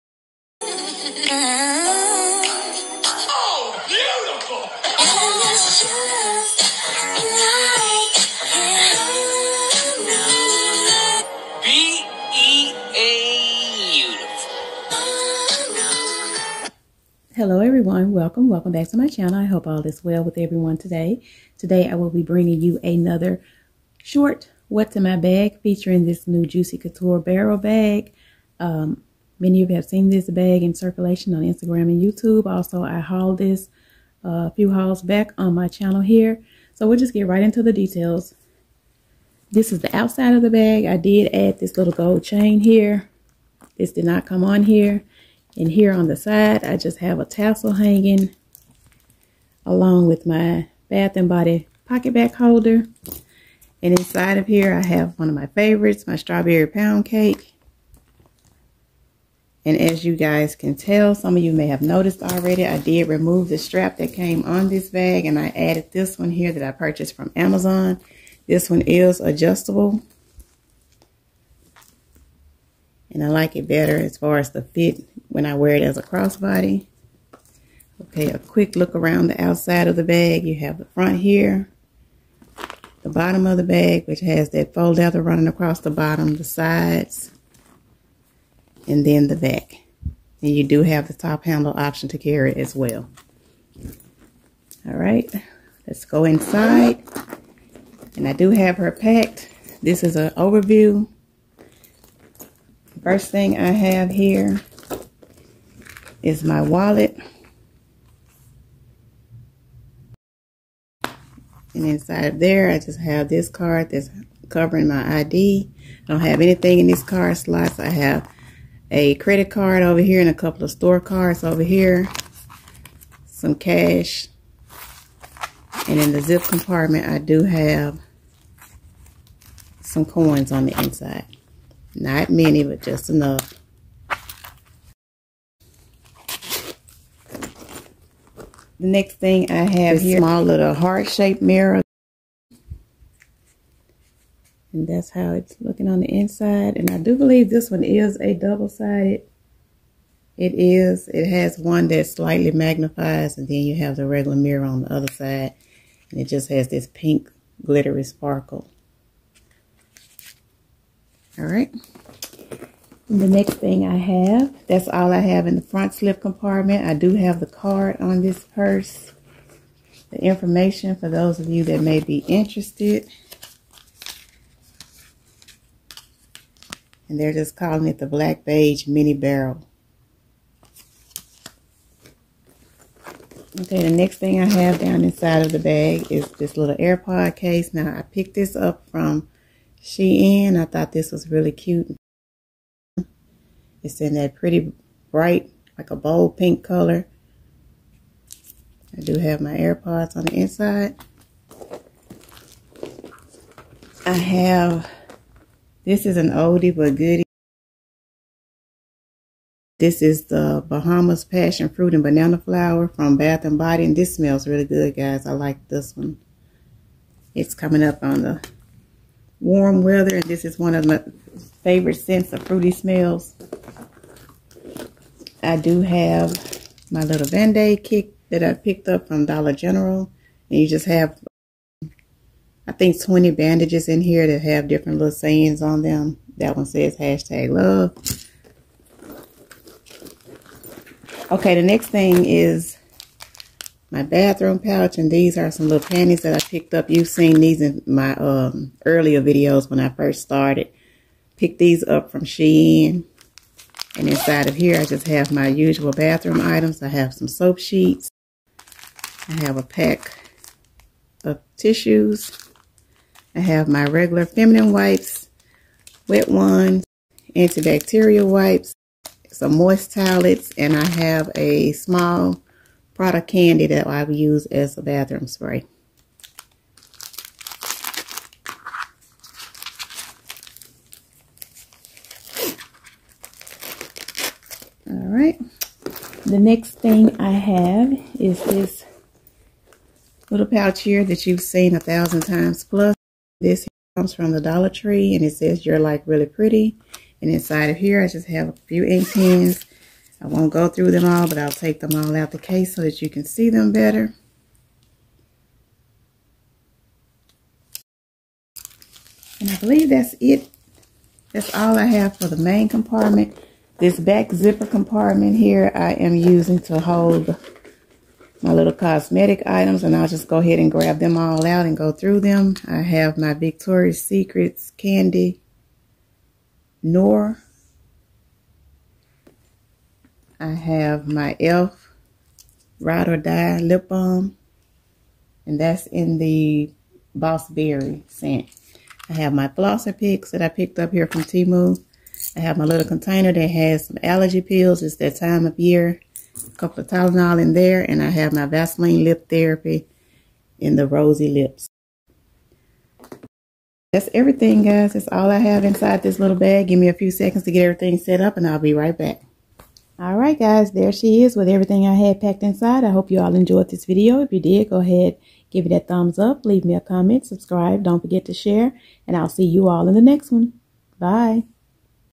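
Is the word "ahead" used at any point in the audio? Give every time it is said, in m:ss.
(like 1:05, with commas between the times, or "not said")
5:20, 6:04.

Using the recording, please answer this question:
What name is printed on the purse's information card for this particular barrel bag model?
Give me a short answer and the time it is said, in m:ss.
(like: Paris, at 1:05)
Black Beige Mini Barrel, at 2:58.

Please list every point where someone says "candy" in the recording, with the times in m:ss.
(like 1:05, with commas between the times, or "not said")
4:33, 5:24.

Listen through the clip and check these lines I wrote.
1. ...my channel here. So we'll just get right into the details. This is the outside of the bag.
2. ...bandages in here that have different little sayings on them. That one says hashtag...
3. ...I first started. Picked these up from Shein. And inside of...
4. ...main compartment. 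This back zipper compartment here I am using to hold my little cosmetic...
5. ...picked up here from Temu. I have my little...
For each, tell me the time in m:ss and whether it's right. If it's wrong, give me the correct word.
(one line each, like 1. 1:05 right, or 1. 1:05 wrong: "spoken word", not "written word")
1. 0:35 right
2. 3:53 right
3. 4:09 right
4. 5:12 right
5. 5:40 right.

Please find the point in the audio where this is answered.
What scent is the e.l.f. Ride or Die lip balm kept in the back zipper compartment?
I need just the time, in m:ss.
5:37.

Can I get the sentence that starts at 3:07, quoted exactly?
Now, I picked this up from Shein.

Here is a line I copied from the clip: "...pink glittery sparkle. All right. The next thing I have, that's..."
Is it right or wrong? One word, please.
right.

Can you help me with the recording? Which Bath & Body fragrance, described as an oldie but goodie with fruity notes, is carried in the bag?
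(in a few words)
Bahamas Passion Fruit and Banana Flower.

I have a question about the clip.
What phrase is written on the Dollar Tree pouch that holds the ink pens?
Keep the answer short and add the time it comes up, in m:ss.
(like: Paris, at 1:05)
You're like really pretty, at 4:55.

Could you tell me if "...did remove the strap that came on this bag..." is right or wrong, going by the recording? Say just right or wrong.
right.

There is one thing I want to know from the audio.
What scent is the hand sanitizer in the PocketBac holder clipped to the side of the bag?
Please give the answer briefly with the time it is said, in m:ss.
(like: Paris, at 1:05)
Strawberry pound cake, at 0:56.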